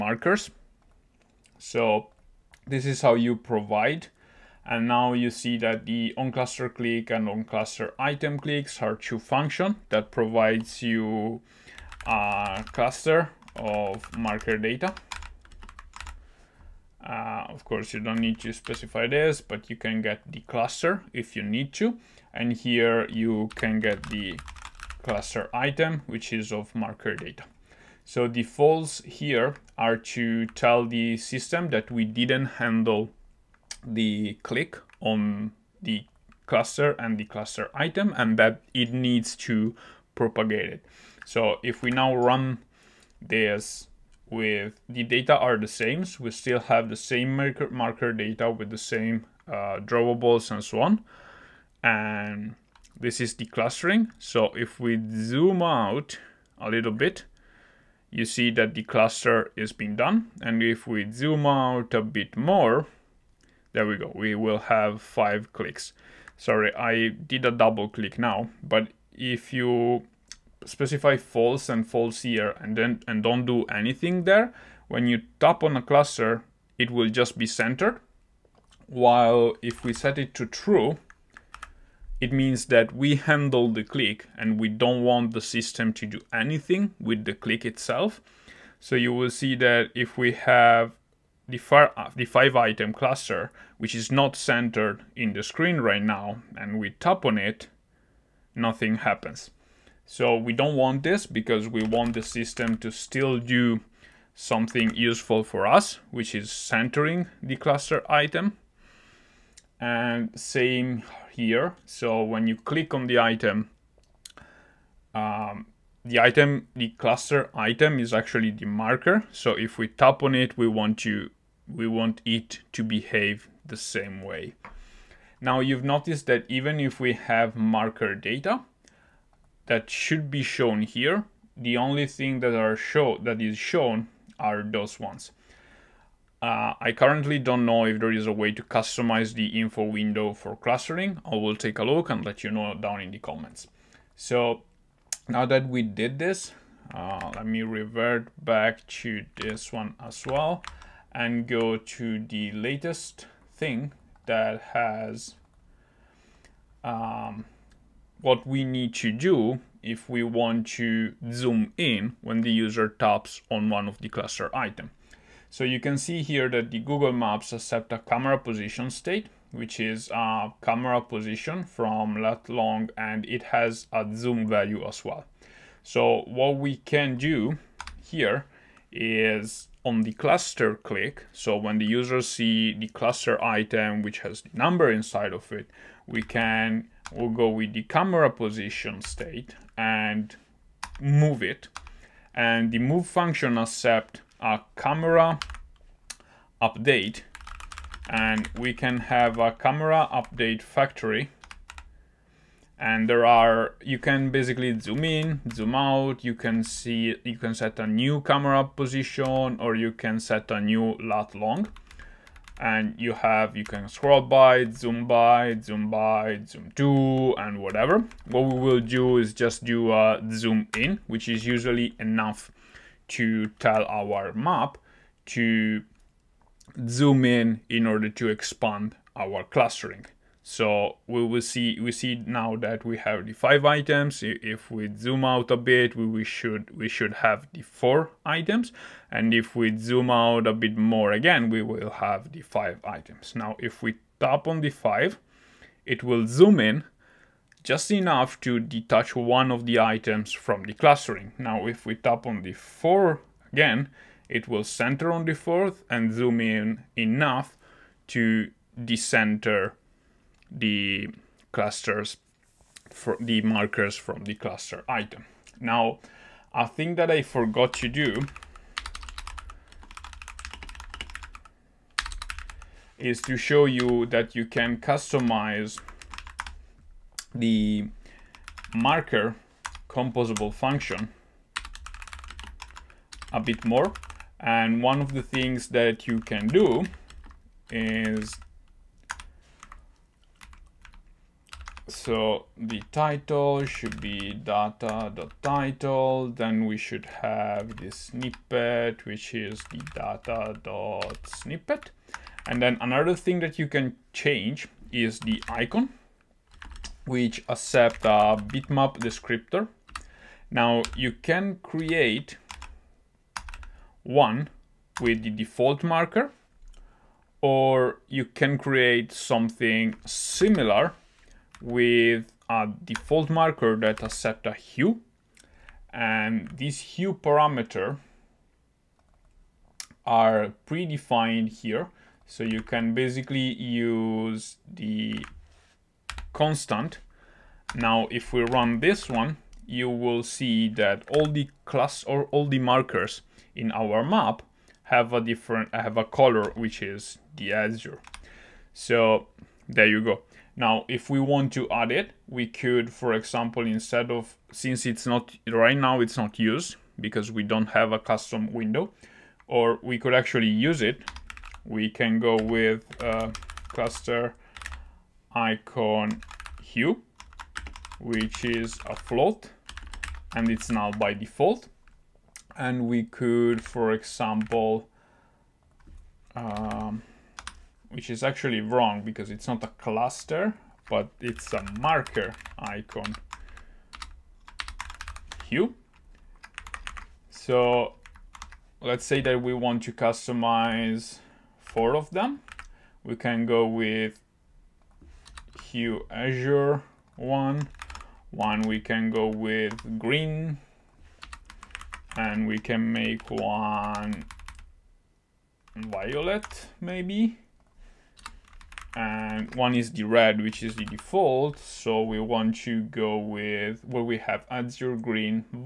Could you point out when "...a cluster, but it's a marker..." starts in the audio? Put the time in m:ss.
6:19.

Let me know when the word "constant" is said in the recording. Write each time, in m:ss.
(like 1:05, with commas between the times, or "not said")
5:36.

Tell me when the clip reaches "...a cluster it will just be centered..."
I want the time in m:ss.
1:15.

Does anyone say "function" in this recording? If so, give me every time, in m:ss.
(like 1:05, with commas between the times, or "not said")
0:09, 3:13, 4:40.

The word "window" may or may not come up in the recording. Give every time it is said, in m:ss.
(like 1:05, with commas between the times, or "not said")
2:19, 5:58.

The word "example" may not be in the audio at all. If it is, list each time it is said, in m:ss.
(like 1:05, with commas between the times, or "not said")
5:53, 6:13.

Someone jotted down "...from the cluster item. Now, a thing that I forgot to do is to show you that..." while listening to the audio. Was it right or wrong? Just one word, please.
right.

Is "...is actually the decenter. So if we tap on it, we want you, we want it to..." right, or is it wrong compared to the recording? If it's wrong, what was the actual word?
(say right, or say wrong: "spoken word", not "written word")
wrong: "marker", not "decenter".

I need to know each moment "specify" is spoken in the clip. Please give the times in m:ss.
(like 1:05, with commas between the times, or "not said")
0:18, 1:10.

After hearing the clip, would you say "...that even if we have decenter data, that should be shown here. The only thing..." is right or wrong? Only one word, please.
wrong.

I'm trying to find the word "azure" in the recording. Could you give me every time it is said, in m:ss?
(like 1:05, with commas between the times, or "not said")
5:47, 6:36, 6:54.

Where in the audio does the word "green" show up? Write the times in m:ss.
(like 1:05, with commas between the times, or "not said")
6:39, 6:54.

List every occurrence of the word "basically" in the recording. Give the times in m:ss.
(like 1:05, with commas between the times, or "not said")
3:24, 5:32.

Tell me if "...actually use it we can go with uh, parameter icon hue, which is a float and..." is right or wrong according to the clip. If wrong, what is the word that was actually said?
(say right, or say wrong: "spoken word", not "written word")
wrong: "cluster", not "parameter".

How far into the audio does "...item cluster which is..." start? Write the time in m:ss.
1:32.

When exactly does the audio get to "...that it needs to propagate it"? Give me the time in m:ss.
0:38.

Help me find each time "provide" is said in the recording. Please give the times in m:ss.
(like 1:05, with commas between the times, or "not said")
0:03, 0:10.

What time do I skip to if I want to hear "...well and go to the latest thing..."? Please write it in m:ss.
2:30.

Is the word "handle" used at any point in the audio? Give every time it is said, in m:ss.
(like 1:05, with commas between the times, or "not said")
0:32, 1:23.